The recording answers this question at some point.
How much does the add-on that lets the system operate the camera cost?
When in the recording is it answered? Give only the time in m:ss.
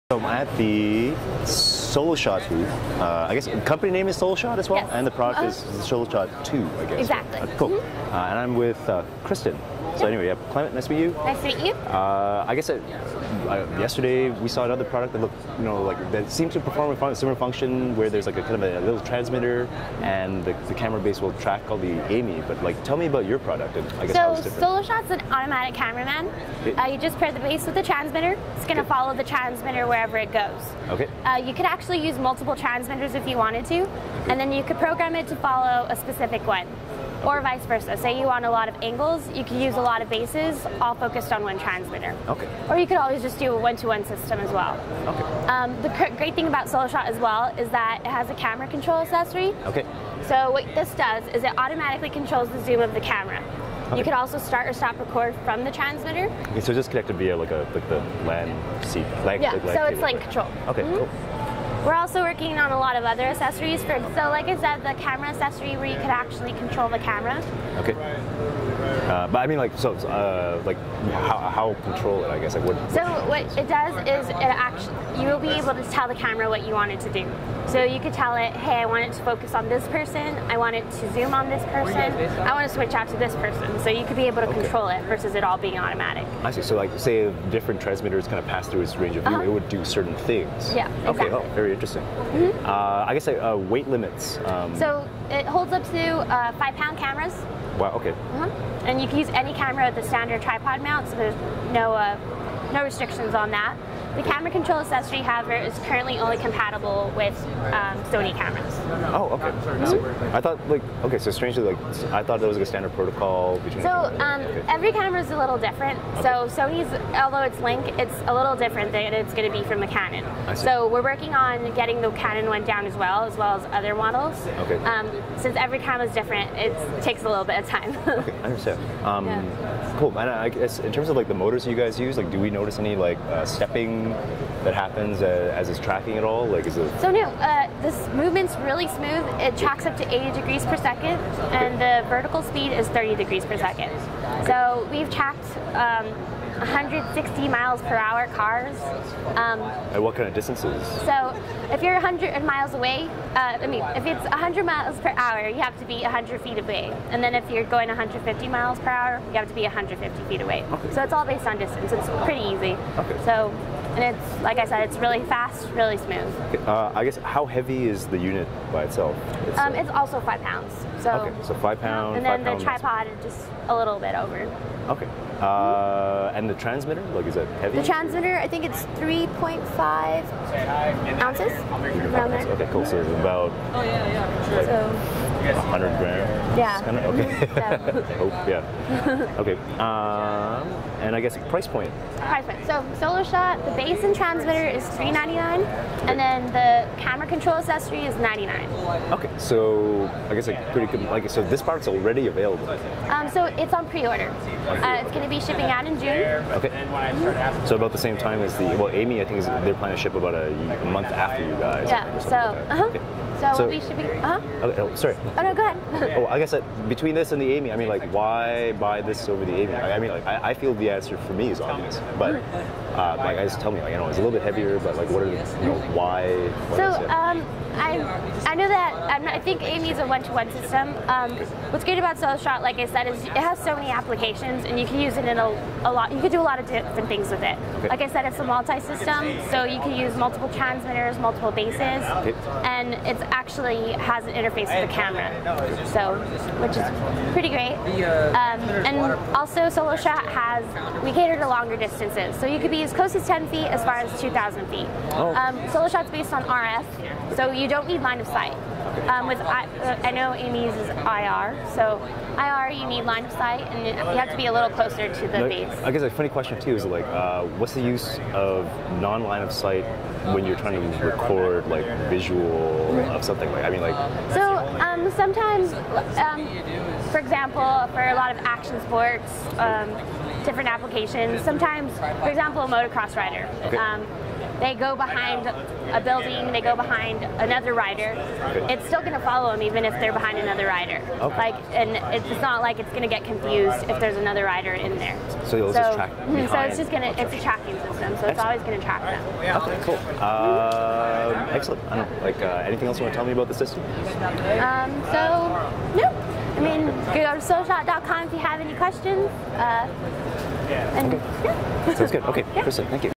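3:18.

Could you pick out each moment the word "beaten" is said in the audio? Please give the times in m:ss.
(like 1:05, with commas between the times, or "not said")
not said.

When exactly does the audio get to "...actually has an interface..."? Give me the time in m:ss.
4:03.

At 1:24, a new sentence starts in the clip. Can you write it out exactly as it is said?
control it versus it all being automatic.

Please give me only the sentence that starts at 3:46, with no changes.
so um, I I know that not, i think Amy's a one-to-one system.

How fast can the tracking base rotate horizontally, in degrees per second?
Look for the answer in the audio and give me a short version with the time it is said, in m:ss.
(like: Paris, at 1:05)
80 degrees per second, at 2:20.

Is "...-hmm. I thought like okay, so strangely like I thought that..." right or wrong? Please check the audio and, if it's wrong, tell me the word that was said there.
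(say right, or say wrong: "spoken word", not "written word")
right.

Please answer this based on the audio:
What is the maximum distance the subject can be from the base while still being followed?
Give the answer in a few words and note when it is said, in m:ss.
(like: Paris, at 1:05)
2,000 feet, at 4:14.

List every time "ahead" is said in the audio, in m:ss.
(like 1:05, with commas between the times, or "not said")
3:35.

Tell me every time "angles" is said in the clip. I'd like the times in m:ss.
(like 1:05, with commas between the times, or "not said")
0:38.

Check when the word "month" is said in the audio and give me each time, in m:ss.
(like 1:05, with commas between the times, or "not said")
3:30.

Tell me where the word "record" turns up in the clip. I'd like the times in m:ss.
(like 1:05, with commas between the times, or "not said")
0:54, 4:31.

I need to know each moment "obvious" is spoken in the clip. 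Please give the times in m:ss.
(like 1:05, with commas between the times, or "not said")
3:41.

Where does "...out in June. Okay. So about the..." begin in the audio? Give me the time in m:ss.
3:25.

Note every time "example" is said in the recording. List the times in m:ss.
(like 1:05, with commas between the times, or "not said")
4:37, 4:42.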